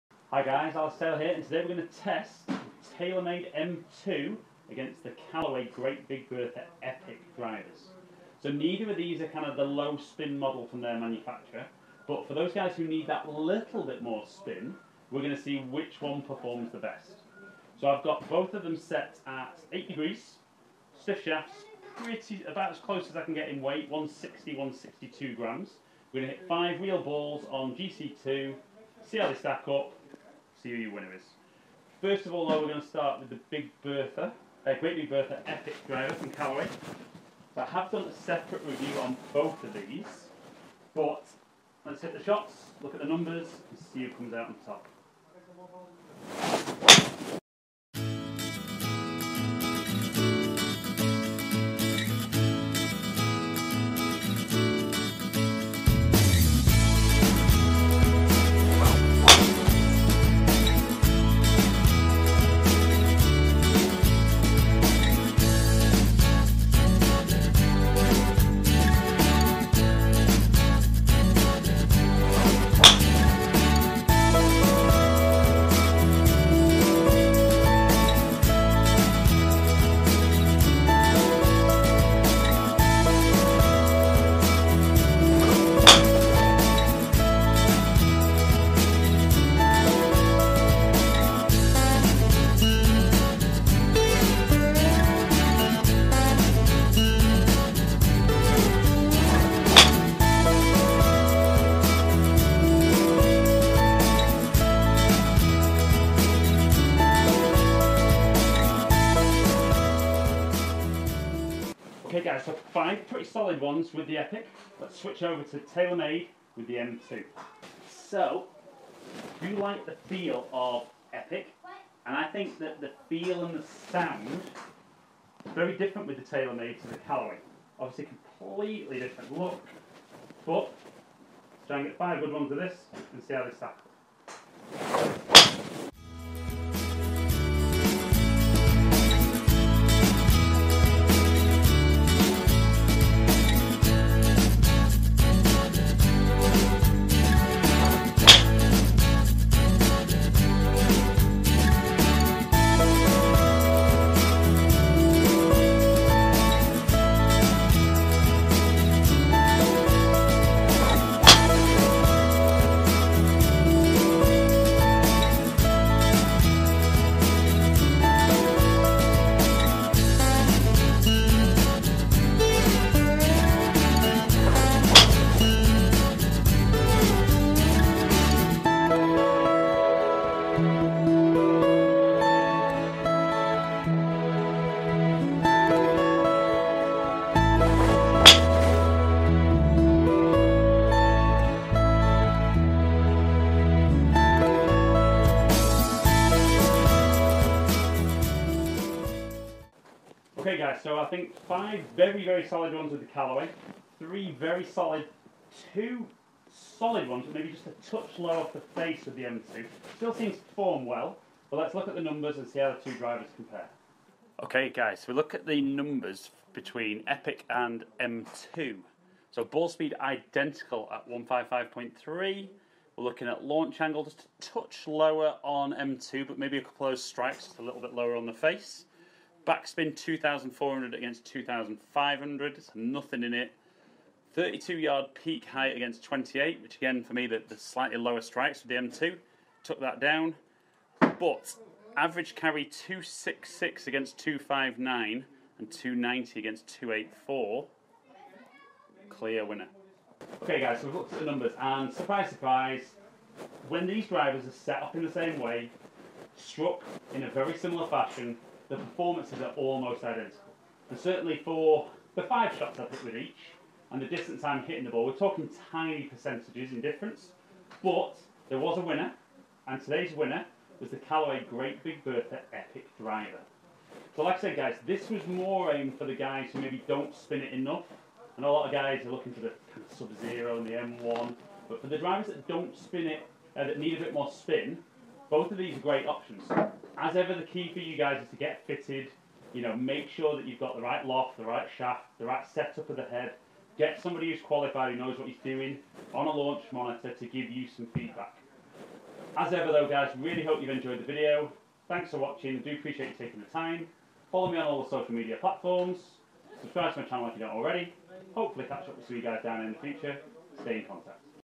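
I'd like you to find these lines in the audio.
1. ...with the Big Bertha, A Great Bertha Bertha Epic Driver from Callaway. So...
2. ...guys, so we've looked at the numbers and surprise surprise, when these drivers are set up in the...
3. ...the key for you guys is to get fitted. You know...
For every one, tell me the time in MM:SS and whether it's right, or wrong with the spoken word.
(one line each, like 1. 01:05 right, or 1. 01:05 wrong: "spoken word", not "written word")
1. 00:33 wrong: "Big", not "Bertha"
2. 04:10 right
3. 04:47 right.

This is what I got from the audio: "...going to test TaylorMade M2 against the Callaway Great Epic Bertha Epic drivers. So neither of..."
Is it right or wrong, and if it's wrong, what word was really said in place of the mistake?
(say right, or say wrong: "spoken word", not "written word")
wrong: "Big", not "Epic".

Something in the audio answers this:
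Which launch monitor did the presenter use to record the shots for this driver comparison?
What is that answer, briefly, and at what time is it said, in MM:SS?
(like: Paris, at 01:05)
GC2, at 00:27.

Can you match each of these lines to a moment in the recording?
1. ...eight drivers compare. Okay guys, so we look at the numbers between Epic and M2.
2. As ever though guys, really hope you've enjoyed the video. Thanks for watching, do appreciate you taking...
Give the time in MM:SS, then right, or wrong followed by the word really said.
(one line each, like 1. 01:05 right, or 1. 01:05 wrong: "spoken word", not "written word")
1. 03:32 wrong: "two", not "eight"
2. 04:59 right.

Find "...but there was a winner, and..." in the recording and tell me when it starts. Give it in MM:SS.
04:27.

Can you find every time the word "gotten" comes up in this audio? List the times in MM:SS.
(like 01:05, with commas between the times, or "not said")
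not said.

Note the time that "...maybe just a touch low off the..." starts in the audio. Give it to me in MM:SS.
03:27.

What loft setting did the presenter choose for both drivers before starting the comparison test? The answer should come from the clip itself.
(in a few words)
8 degrees.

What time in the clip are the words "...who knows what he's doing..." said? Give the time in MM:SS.
04:54.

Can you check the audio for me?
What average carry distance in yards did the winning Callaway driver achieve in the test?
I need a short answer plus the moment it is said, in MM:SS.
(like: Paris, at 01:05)
266, at 04:02.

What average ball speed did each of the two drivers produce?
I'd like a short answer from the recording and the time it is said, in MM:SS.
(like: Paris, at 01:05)
155.3, at 03:41.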